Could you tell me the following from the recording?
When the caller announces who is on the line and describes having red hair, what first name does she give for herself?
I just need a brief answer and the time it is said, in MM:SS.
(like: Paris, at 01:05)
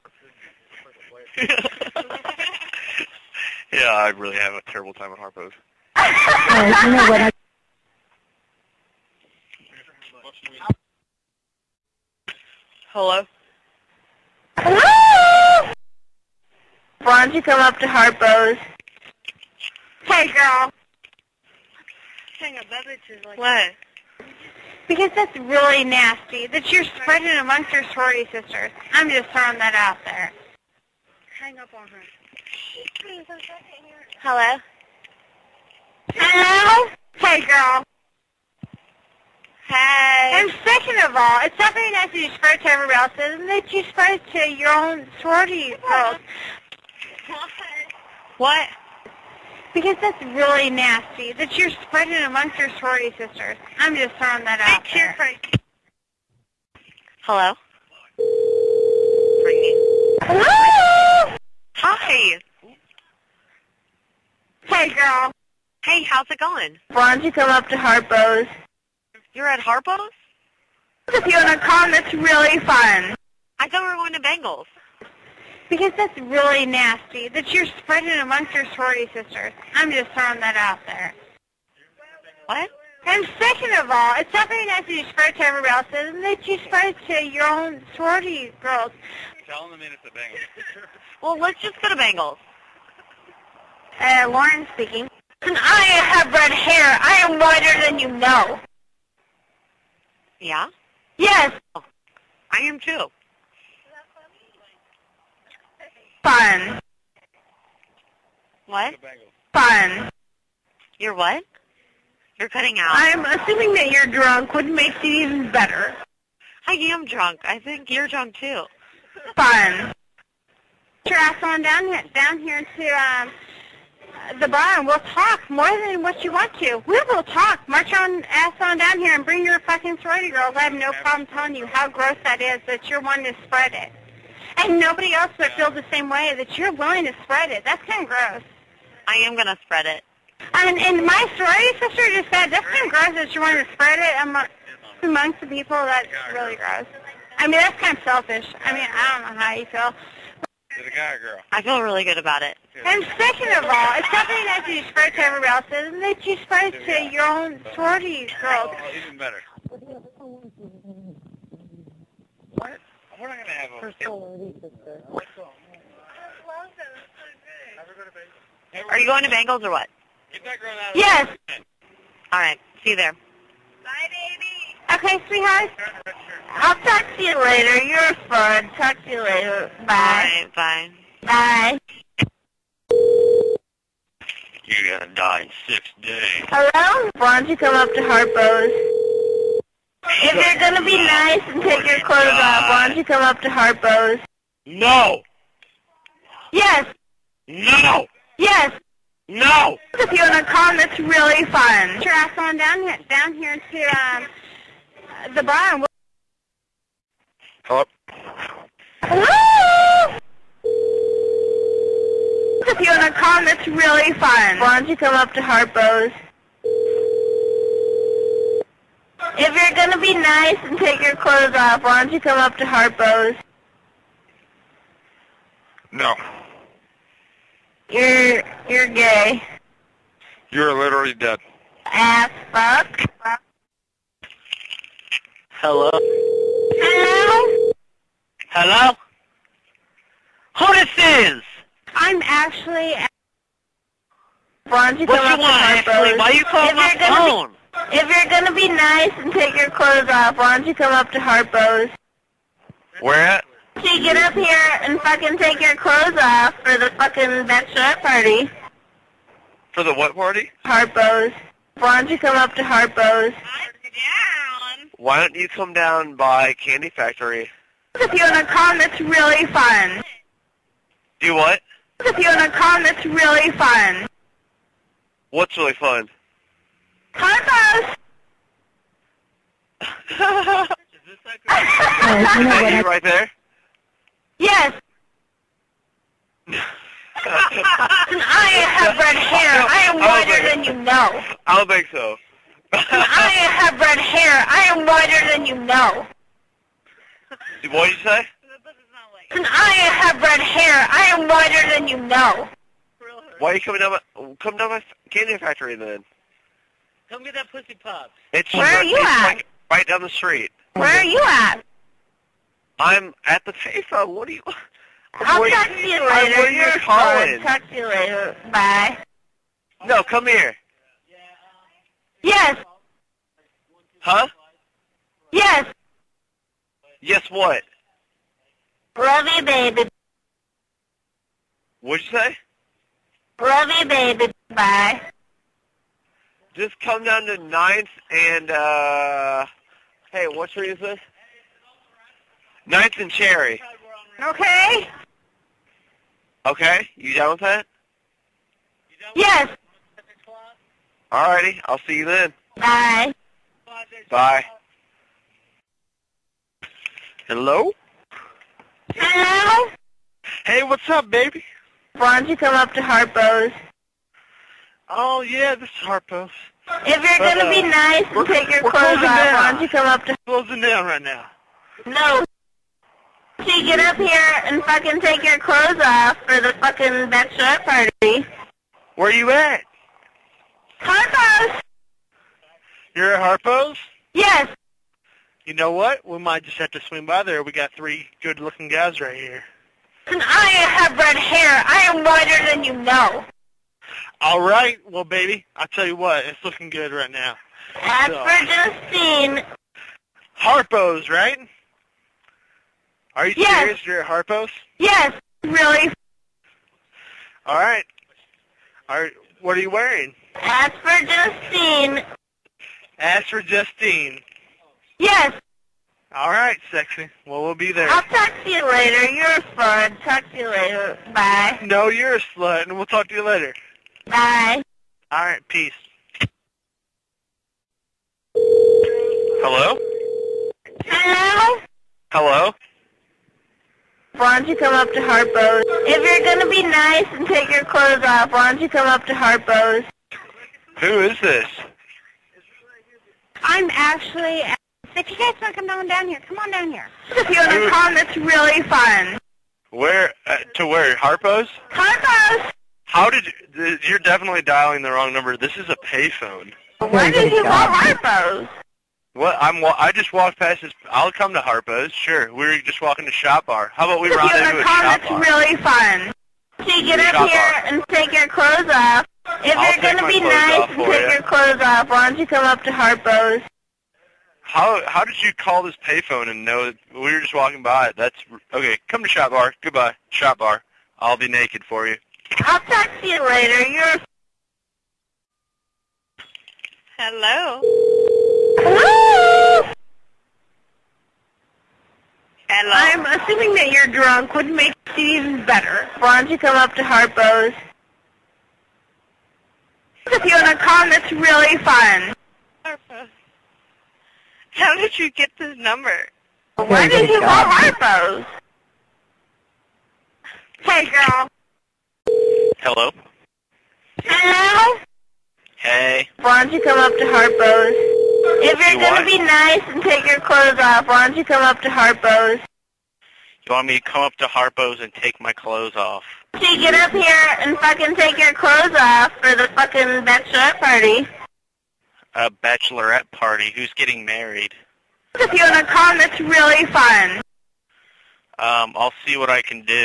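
Lauren, at 01:34.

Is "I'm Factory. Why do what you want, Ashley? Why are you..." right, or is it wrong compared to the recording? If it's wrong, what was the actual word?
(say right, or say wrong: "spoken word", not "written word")
wrong: "Ashley", not "Factory".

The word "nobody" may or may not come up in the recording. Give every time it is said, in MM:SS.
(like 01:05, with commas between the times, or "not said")
02:14.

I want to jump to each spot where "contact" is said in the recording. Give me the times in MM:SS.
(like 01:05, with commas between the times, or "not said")
not said.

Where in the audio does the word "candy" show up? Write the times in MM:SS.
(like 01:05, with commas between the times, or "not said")
04:26, 05:05.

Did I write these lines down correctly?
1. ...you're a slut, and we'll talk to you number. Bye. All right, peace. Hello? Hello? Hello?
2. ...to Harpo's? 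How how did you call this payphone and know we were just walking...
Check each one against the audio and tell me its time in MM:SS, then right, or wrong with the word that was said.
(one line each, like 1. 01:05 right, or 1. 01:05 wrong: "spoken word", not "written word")
1. 07:01 wrong: "later", not "number"
2. 07:52 right.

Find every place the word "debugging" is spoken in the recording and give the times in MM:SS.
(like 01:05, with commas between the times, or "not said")
not said.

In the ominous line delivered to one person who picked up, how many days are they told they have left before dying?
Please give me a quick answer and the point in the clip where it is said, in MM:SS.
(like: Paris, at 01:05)
6, at 03:05.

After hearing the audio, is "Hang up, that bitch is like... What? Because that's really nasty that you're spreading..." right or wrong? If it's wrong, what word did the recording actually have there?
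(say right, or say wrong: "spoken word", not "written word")
right.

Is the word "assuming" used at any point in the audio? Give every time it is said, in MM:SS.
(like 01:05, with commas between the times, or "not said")
01:53, 08:13.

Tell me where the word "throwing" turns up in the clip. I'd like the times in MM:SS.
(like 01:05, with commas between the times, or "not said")
00:29, 00:54, 01:20.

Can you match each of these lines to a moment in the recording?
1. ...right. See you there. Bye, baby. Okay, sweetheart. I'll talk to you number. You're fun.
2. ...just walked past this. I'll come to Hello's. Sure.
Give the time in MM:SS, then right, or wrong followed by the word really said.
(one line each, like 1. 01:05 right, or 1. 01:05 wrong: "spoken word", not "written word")
1. 02:52 wrong: "later", not "number"
2. 07:39 wrong: "Harpo", not "Hello".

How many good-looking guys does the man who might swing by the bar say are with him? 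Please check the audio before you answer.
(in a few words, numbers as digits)
3.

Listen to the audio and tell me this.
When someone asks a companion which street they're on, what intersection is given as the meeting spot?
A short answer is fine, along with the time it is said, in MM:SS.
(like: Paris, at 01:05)
Ninth and Cherry, at 05:42.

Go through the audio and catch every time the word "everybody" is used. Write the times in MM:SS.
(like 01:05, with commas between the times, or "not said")
00:42, 01:25, 02:35.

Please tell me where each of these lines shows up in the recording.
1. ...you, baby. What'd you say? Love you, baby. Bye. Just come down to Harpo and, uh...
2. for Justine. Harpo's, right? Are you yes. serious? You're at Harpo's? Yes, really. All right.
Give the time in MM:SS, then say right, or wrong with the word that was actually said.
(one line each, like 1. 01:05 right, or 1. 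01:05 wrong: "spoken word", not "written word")
1. 05:29 wrong: "Ninth", not "Harpo"
2. 06:38 right.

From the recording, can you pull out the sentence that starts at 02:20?
And, and my sorority sister just said, that's kind of gross that you're wanting to spread it among, amongst the people.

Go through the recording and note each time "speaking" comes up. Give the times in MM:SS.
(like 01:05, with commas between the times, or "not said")
01:34.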